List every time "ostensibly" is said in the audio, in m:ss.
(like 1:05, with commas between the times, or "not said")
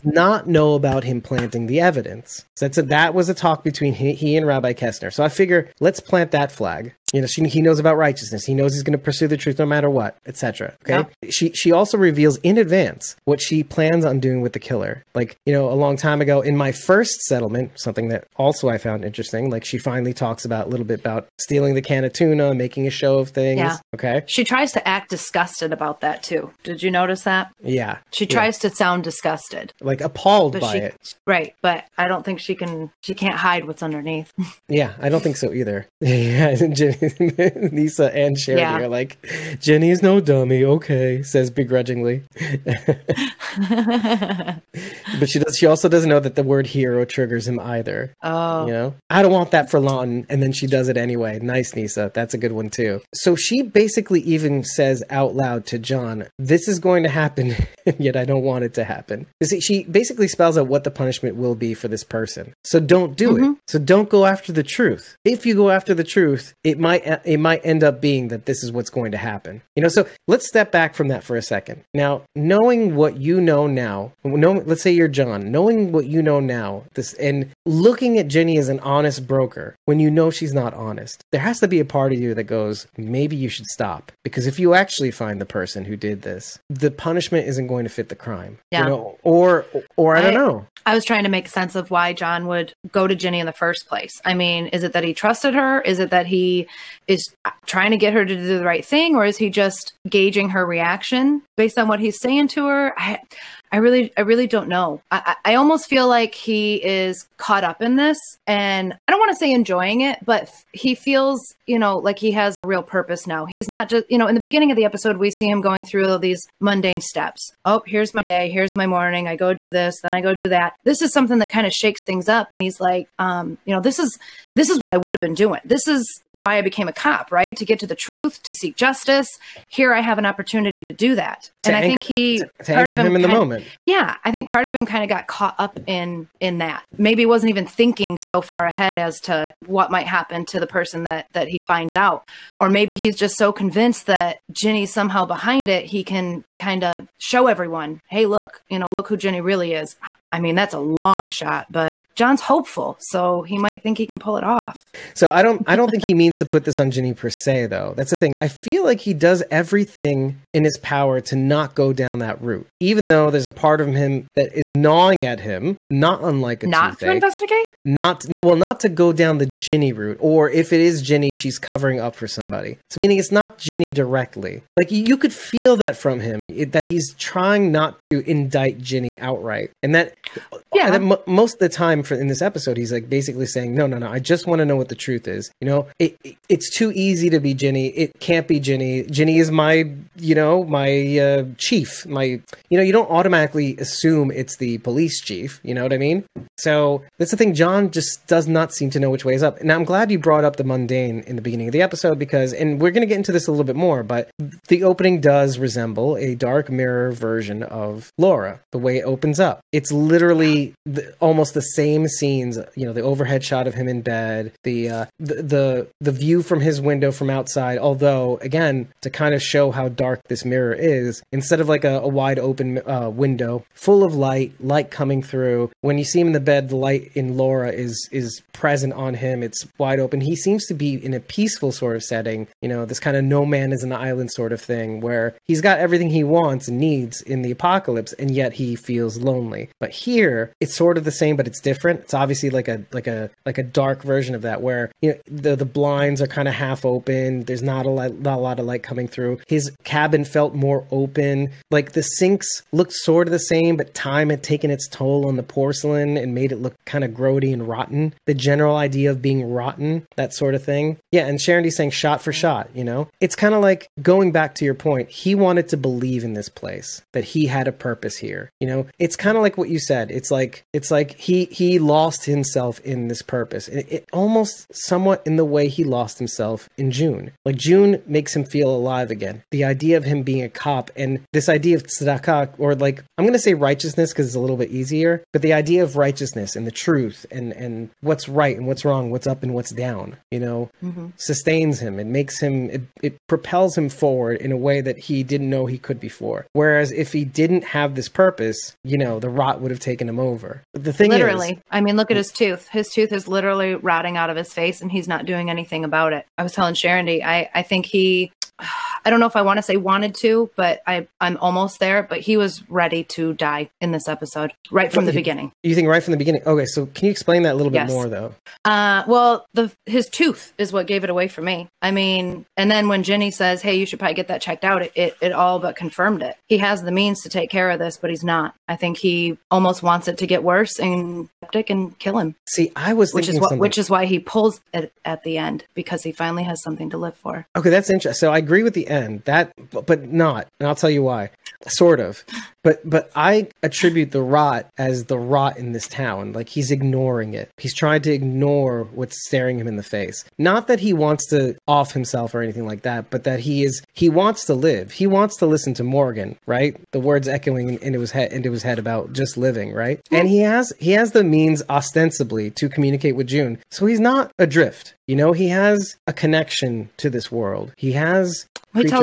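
6:01.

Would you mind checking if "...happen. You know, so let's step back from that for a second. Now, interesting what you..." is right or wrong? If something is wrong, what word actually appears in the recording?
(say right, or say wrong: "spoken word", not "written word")
wrong: "knowing", not "interesting".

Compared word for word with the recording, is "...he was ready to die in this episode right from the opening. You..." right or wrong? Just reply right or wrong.
wrong.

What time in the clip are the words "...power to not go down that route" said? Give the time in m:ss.
2:40.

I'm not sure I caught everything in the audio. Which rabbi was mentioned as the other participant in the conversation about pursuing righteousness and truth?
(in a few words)
Rabbi Kessner.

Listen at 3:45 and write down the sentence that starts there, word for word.
When you see him in the bed, the light in Laura is is present on him.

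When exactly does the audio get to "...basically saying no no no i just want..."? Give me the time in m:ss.
3:03.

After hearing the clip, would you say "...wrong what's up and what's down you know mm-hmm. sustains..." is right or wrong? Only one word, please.
right.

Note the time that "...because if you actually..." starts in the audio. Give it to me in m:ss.
1:24.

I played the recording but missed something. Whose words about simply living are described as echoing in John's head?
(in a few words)
Morgan.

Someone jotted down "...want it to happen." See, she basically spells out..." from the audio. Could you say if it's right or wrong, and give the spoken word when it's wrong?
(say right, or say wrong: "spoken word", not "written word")
right.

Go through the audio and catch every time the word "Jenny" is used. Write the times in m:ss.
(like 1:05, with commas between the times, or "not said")
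0:39, 1:18, 1:33, 2:29, 5:23.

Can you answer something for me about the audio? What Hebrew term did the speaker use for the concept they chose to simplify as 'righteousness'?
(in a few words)
Tzedakah.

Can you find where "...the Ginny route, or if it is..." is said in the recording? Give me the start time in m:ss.
2:49.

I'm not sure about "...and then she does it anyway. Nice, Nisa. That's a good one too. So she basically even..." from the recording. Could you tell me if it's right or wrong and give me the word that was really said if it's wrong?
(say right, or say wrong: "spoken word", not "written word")
right.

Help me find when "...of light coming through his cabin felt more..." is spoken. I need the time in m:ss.
4:08.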